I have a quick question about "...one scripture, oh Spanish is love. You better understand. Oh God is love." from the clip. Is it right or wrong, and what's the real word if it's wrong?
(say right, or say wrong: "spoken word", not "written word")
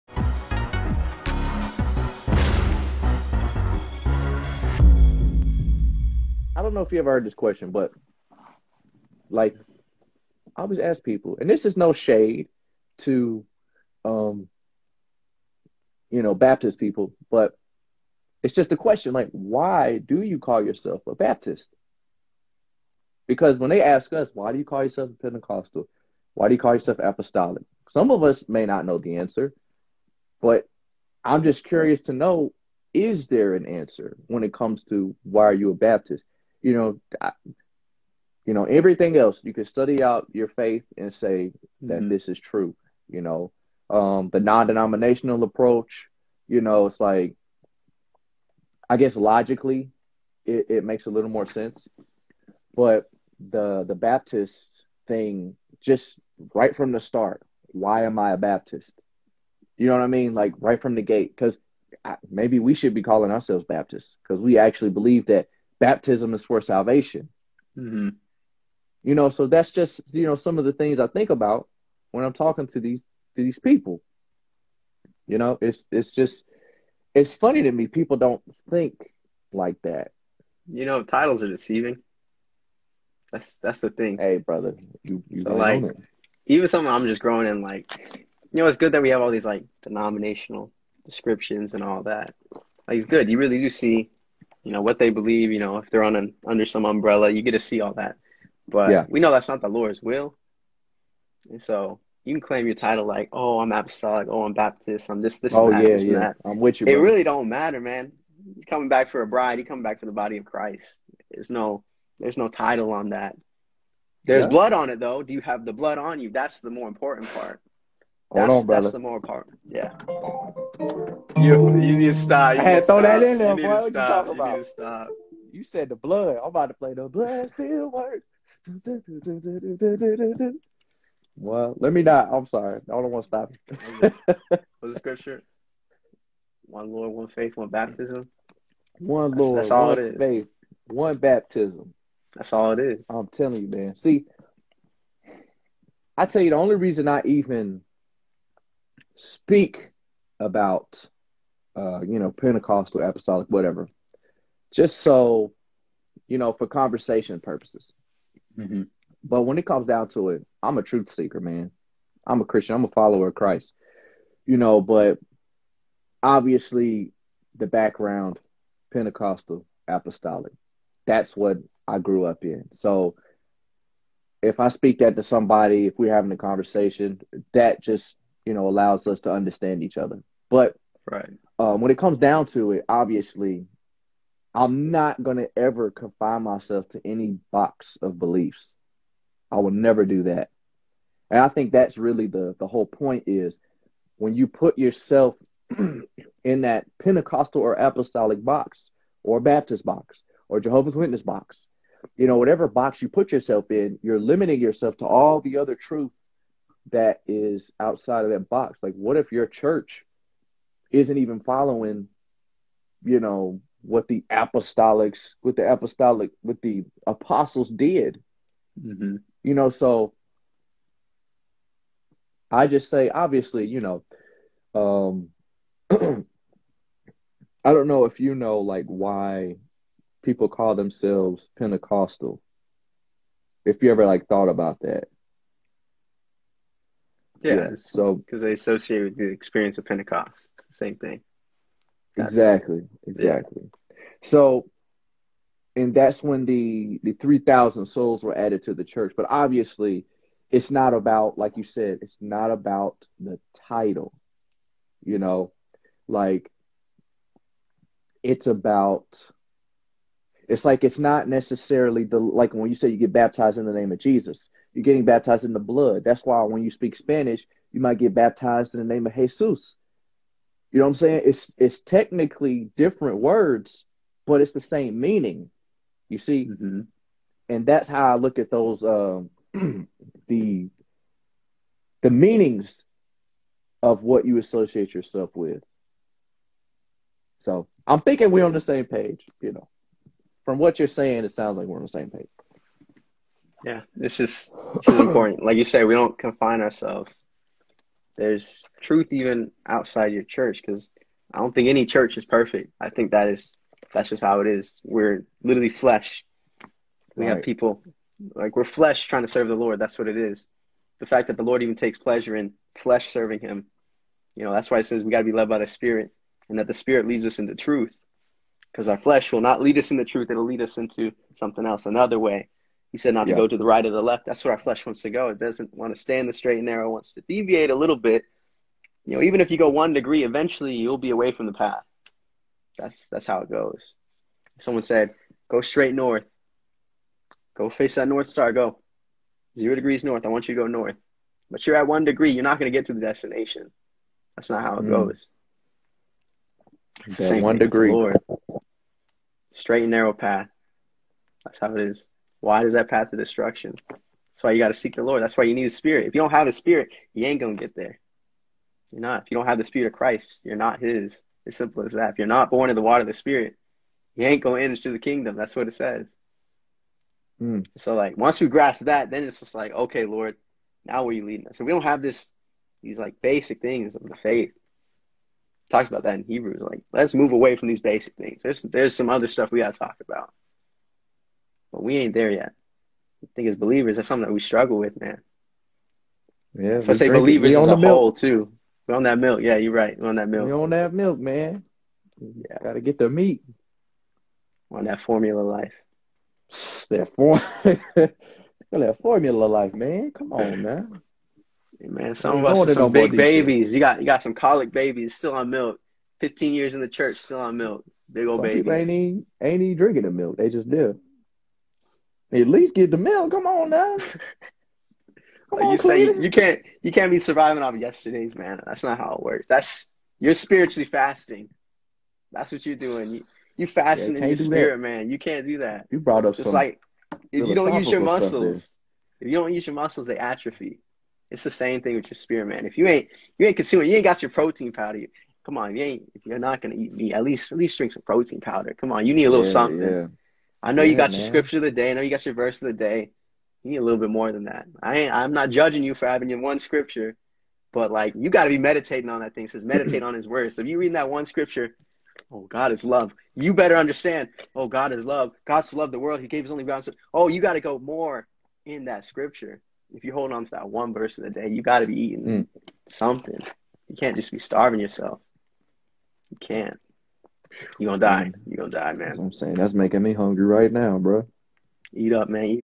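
wrong: "God", not "Spanish".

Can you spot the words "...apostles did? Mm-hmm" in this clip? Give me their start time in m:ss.
3:37.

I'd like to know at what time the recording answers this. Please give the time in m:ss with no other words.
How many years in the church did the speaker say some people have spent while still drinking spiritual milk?
6:46.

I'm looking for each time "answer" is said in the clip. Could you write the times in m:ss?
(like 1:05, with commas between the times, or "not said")
0:29, 0:33.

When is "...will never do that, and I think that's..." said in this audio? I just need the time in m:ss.
3:09.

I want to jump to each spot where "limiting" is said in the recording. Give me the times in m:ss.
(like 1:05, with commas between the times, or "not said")
3:24.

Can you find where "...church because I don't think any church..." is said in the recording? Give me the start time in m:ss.
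5:00.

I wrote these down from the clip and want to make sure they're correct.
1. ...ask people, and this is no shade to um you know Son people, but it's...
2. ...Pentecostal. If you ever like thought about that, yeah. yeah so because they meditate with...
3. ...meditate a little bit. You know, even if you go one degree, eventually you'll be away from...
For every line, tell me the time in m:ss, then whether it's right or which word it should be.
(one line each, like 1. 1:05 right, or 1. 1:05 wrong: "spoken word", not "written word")
1. 0:10 wrong: "Baptist", not "Son"
2. 3:51 wrong: "associate", not "meditate"
3. 5:27 wrong: "deviate", not "meditate".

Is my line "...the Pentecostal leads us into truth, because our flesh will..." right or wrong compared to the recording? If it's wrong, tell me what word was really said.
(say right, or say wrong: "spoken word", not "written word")
wrong: "Spirit", not "Pentecostal".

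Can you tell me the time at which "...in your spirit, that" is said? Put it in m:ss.
7:04.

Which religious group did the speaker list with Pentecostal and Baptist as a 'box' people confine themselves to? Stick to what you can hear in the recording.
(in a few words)
Jehovah's Witness.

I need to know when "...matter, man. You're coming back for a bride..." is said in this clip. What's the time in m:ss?
1:47.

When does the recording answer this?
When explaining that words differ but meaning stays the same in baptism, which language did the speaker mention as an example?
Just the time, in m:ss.
4:26.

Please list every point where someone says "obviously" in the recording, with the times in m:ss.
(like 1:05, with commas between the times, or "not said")
2:46, 3:02, 3:43, 4:09.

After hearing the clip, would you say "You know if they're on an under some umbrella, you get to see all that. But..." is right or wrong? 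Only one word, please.
right.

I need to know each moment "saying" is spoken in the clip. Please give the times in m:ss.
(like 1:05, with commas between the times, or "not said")
4:30, 4:50, 7:49.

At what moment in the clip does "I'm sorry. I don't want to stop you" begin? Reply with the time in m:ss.
2:12.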